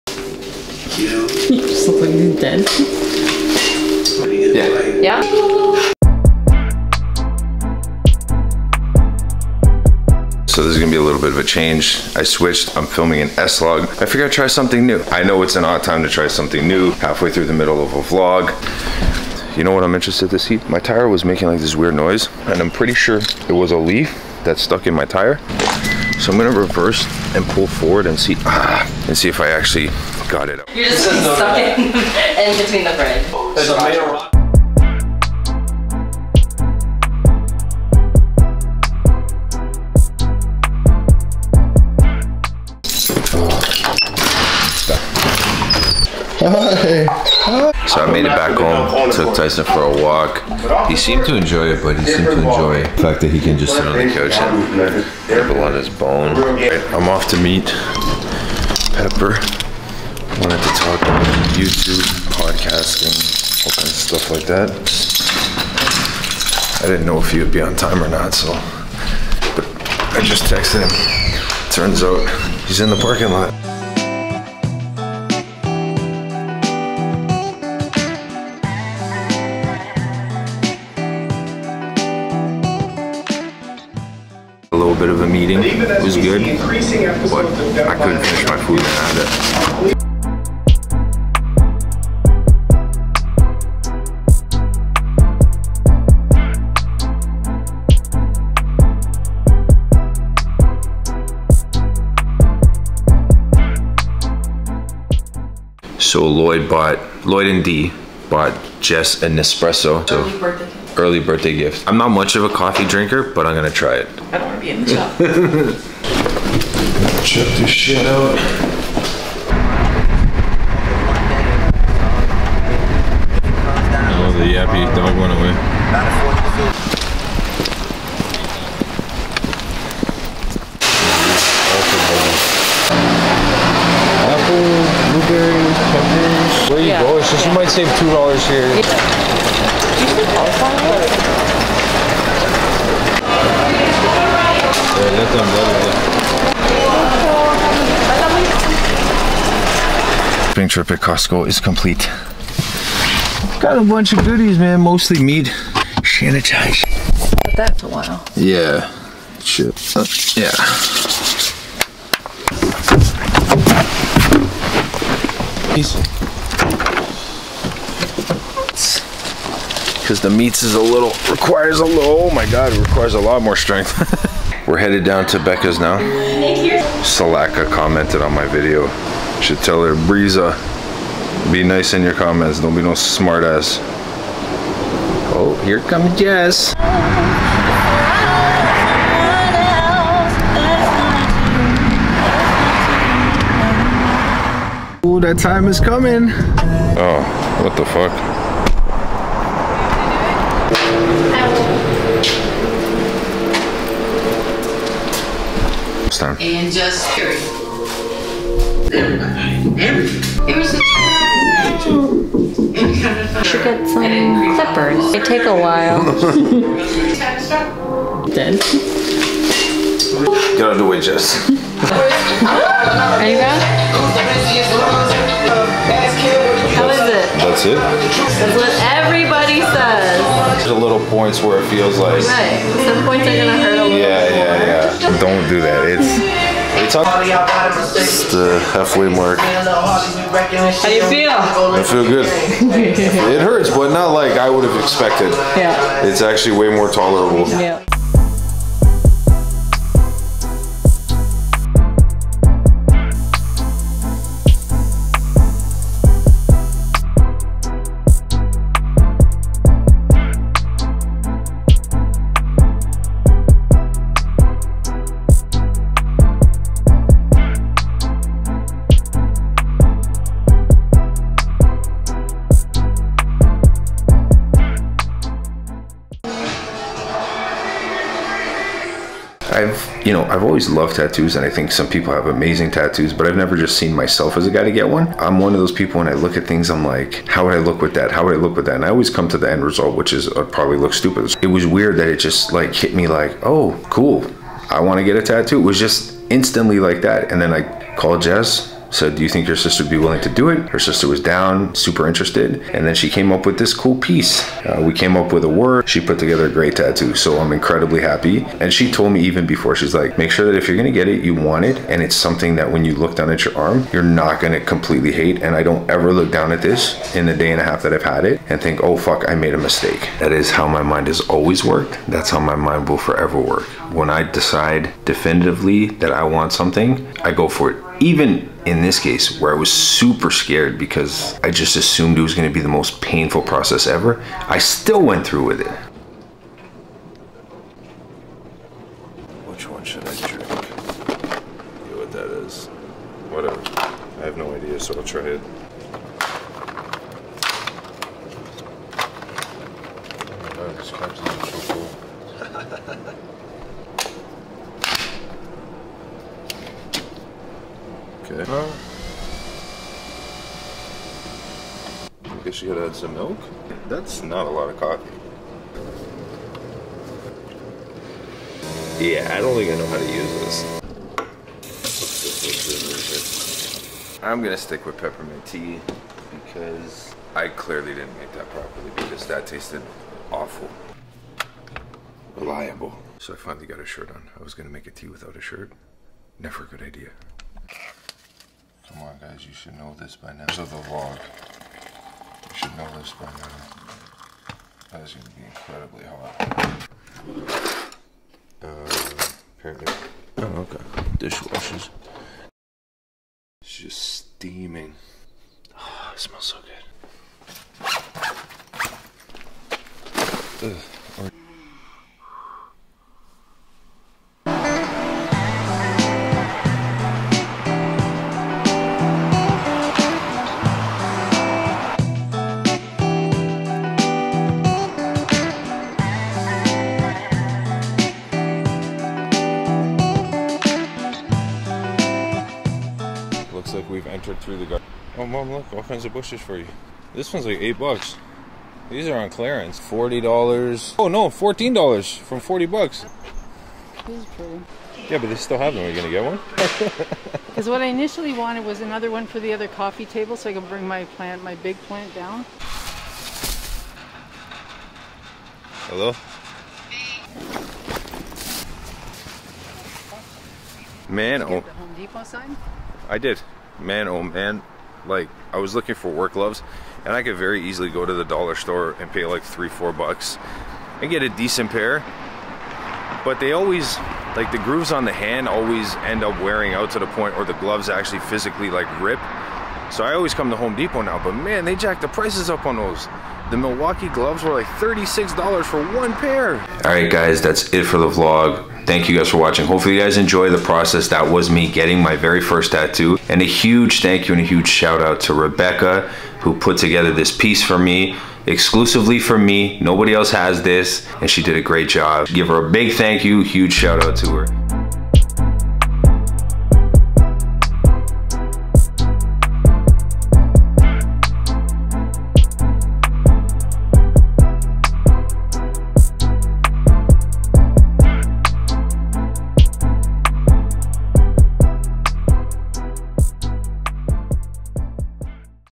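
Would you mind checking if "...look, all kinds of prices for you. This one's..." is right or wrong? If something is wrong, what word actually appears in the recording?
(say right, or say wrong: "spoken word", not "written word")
wrong: "bushes", not "prices".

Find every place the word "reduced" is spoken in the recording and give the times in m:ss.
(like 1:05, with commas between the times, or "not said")
not said.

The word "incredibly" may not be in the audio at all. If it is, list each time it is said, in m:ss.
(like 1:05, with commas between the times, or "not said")
5:07, 6:35.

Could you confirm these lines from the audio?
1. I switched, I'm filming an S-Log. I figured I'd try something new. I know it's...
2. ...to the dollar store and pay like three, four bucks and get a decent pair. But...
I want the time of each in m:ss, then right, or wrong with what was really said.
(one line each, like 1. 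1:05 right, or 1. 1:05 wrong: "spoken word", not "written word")
1. 0:12 right
2. 7:48 right.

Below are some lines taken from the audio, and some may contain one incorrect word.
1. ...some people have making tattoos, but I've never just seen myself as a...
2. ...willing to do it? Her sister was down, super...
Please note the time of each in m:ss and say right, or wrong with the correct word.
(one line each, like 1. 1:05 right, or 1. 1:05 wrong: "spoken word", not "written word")
1. 4:41 wrong: "amazing", not "making"
2. 4:59 right.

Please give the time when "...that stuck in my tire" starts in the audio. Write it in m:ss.
0:24.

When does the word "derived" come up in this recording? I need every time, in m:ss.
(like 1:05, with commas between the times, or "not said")
not said.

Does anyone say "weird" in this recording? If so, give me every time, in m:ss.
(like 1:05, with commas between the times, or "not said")
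0:21, 4:51.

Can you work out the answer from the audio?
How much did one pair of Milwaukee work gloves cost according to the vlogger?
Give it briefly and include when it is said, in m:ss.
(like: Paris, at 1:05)
$36, at 8:04.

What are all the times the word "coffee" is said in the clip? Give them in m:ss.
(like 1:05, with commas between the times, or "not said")
1:52, 6:04, 7:29.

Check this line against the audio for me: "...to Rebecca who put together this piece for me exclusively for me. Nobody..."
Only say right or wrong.
right.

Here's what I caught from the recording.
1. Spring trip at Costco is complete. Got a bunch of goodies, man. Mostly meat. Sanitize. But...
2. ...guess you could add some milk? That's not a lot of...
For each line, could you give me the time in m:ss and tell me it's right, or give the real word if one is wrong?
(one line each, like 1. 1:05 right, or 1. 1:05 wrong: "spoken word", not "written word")
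1. 2:30 right
2. 6:02 right.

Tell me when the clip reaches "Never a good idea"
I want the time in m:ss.
6:26.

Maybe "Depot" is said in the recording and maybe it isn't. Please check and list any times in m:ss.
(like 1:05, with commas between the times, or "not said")
7:41, 8:00.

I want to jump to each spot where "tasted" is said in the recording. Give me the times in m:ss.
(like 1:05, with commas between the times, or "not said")
6:19.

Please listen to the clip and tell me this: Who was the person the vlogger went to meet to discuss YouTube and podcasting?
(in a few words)
Pepper.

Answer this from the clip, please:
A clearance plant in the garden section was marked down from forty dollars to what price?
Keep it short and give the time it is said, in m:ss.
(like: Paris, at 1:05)
$14, at 7:21.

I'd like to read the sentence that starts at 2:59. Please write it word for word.
Should tell her, Breeza, be nice in your comments.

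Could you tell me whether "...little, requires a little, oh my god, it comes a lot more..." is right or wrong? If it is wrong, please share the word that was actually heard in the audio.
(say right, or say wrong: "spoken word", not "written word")
wrong: "requires", not "comes".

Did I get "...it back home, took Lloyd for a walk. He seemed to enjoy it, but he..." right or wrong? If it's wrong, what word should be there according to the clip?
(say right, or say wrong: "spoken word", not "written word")
wrong: "Tyson", not "Lloyd".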